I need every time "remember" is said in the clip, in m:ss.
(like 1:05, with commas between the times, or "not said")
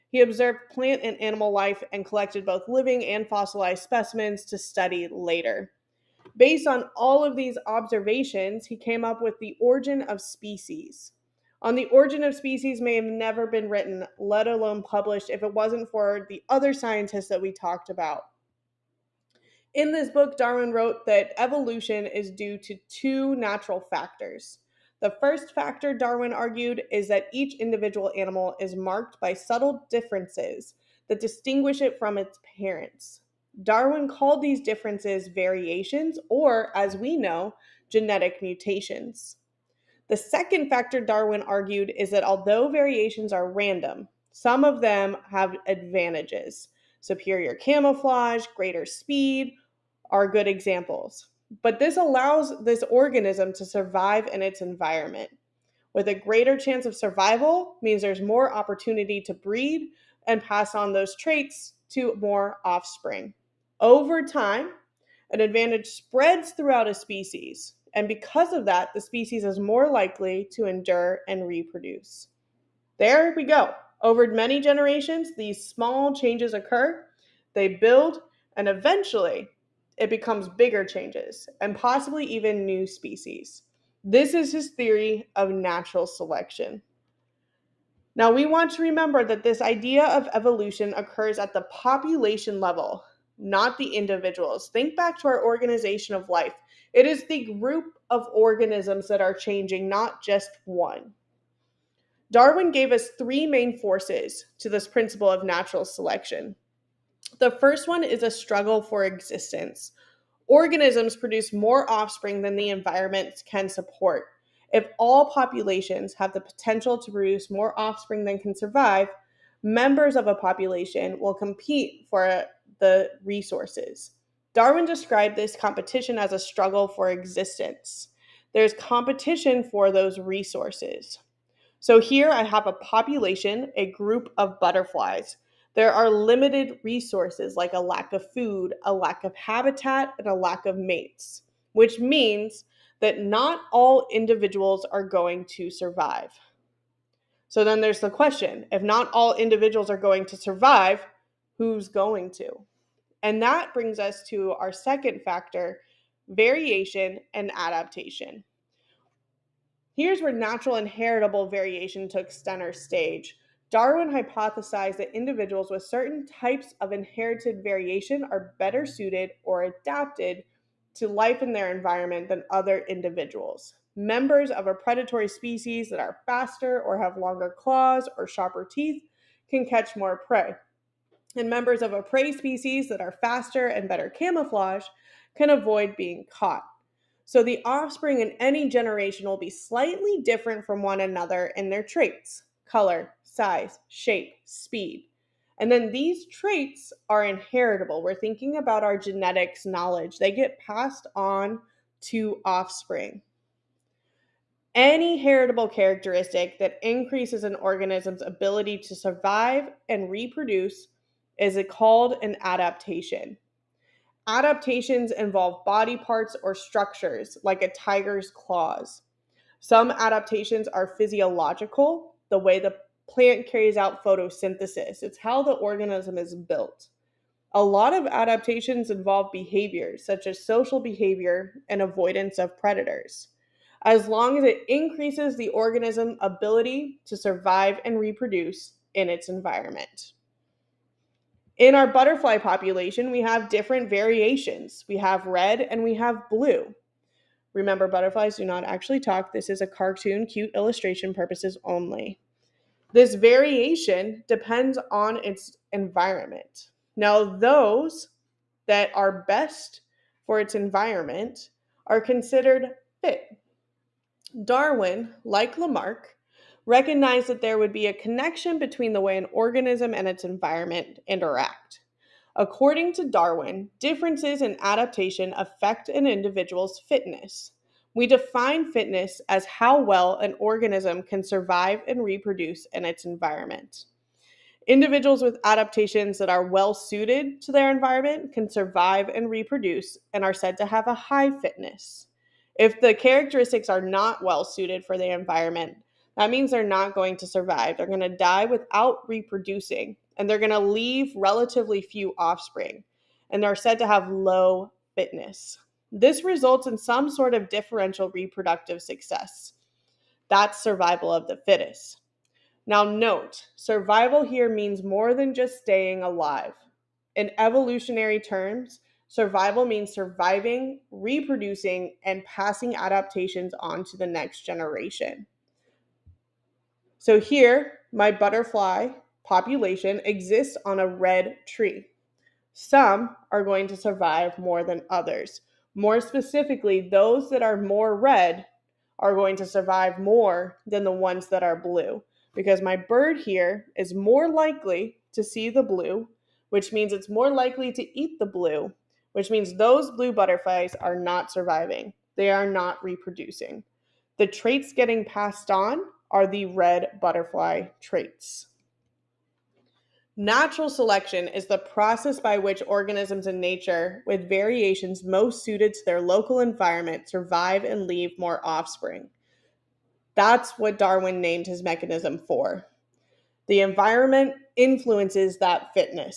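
1:28, 4:07.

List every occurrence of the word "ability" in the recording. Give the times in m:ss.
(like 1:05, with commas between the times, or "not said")
3:28, 3:56.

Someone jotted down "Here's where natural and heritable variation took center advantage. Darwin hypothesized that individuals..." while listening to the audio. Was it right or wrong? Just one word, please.
wrong.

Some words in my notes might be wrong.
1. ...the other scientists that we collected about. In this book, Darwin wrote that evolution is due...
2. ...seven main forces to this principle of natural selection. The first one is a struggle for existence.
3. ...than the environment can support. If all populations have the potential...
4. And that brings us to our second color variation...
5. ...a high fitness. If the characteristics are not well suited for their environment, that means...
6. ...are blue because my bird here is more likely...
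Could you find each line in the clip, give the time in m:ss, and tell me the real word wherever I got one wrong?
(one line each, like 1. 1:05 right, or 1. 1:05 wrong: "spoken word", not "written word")
1. 0:16 wrong: "talked", not "collected"
2. 1:43 wrong: "three", not "seven"
3. 1:52 right
4. 2:33 wrong: "factor", not "color"
5. 4:50 right
6. 5:41 right.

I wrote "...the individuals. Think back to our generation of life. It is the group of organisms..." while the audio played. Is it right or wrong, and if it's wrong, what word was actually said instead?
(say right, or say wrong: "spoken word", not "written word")
wrong: "organization", not "generation".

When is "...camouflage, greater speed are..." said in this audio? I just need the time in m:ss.
0:47.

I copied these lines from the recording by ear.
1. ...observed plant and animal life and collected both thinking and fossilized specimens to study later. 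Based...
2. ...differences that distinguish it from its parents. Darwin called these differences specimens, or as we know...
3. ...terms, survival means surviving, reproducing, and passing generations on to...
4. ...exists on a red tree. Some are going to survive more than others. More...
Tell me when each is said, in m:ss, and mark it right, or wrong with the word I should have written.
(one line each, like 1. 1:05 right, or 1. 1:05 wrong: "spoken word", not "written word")
1. 0:00 wrong: "living", not "thinking"
2. 0:29 wrong: "variations", not "specimens"
3. 5:18 wrong: "adaptations", not "generations"
4. 5:30 right.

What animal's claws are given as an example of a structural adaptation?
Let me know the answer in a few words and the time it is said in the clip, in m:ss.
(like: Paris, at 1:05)
tiger, at 3:37.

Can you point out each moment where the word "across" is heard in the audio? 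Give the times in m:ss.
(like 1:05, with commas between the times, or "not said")
not said.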